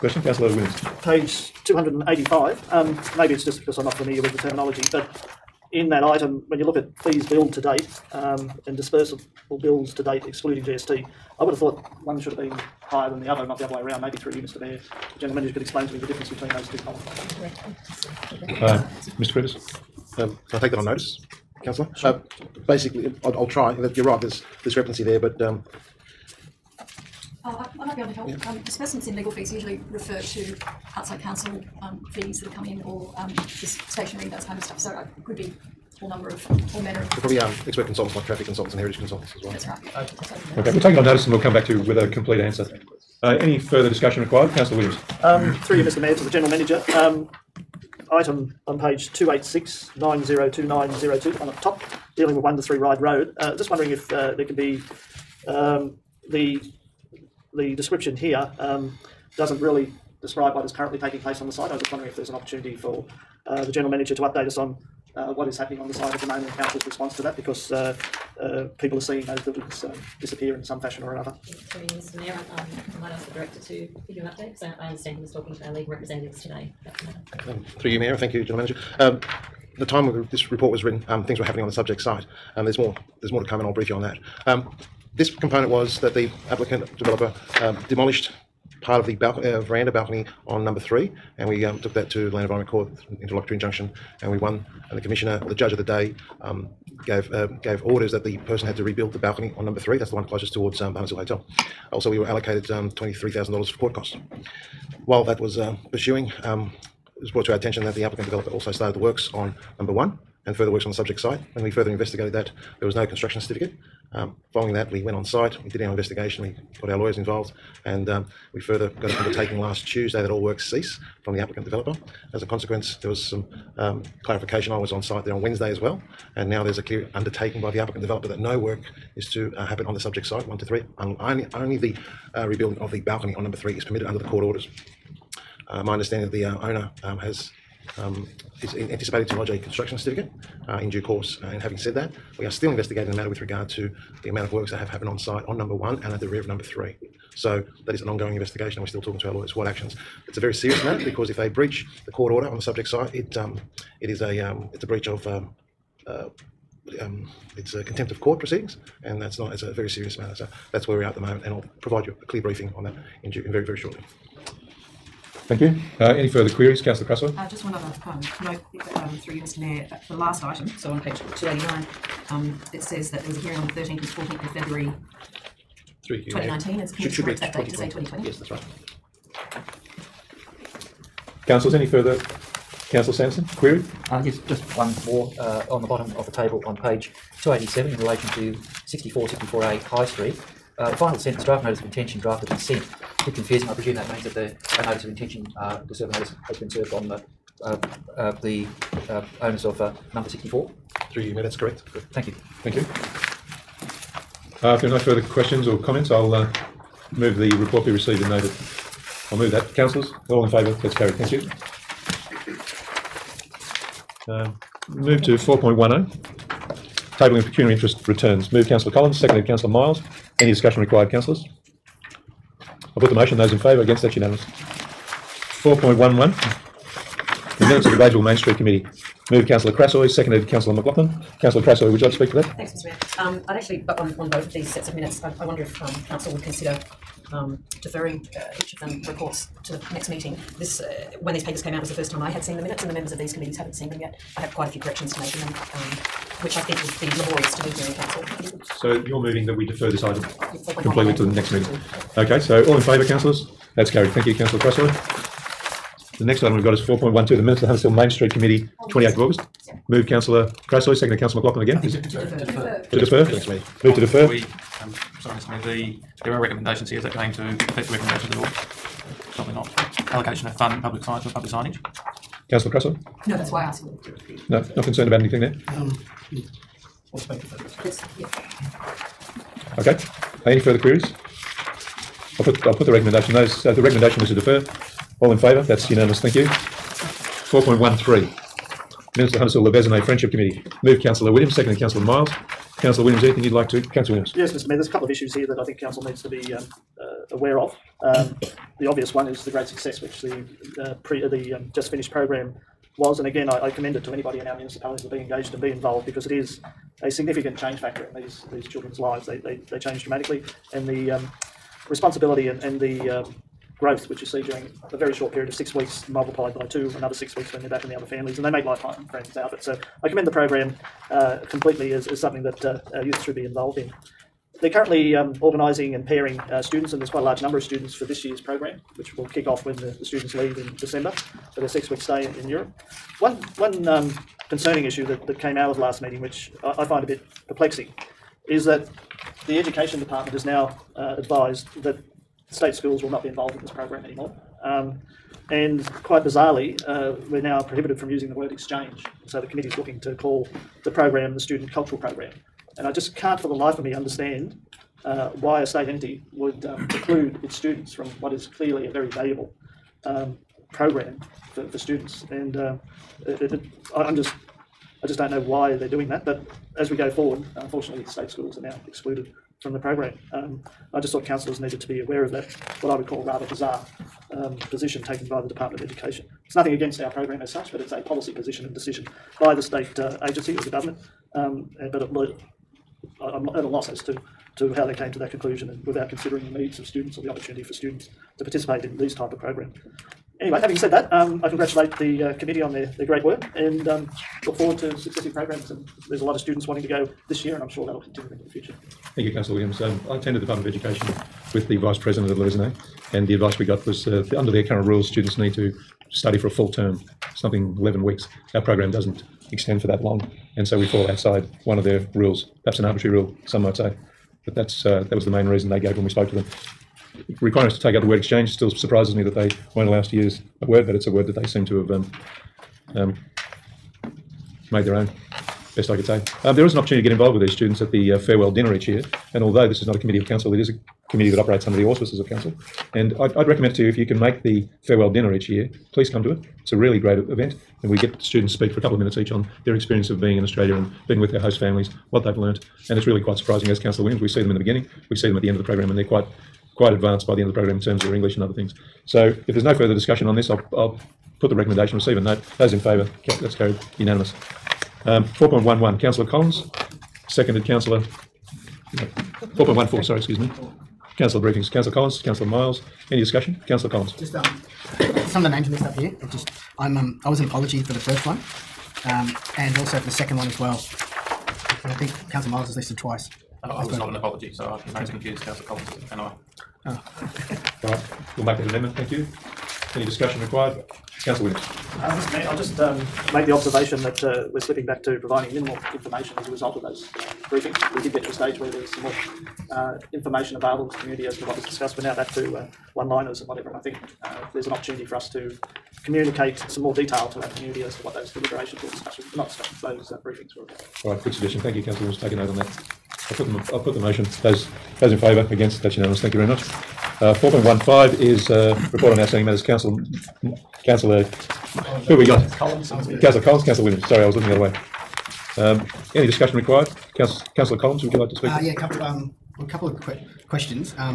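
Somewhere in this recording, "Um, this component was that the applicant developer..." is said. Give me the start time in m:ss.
1:24.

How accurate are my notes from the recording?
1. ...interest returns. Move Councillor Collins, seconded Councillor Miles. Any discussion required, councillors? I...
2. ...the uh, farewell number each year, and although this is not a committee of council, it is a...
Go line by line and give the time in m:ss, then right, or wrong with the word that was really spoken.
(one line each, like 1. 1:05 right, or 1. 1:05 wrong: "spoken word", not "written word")
1. 3:37 right
2. 7:07 wrong: "dinner", not "number".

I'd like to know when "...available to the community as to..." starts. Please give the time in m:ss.
8:10.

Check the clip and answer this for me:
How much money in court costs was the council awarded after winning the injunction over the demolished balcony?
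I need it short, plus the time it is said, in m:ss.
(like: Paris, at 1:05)
$23,000, at 1:42.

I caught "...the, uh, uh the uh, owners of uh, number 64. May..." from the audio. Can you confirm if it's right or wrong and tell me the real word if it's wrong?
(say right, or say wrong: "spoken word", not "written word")
right.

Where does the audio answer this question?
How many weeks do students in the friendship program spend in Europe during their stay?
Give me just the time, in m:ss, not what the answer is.
5:31.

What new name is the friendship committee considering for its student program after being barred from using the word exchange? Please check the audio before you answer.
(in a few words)
student cultural program.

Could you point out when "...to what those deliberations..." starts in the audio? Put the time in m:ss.
8:17.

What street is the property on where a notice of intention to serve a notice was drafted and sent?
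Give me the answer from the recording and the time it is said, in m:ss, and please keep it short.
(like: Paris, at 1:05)
High Street, at 3:09.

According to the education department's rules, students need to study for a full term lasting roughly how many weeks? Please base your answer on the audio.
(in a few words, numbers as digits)
11.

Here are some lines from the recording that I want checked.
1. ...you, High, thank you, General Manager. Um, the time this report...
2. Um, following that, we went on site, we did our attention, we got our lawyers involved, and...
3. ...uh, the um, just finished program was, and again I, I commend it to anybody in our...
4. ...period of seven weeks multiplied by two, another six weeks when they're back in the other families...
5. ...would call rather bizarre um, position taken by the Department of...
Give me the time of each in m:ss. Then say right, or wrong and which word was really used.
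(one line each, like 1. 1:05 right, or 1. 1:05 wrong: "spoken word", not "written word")
1. 1:17 wrong: "Mayor", not "High"
2. 1:54 wrong: "investigation", not "attention"
3. 5:01 right
4. 5:15 wrong: "six", not "seven"
5. 6:12 right.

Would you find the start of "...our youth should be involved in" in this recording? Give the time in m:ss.
5:22.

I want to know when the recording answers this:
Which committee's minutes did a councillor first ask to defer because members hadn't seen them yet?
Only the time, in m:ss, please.
3:47.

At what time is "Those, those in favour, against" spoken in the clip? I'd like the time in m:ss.
8:24.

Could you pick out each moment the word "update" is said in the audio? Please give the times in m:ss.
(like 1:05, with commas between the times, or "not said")
1:04, 1:14.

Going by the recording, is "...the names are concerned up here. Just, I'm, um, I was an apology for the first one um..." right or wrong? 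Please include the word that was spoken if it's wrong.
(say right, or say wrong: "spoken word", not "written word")
wrong: "mixed", not "concerned".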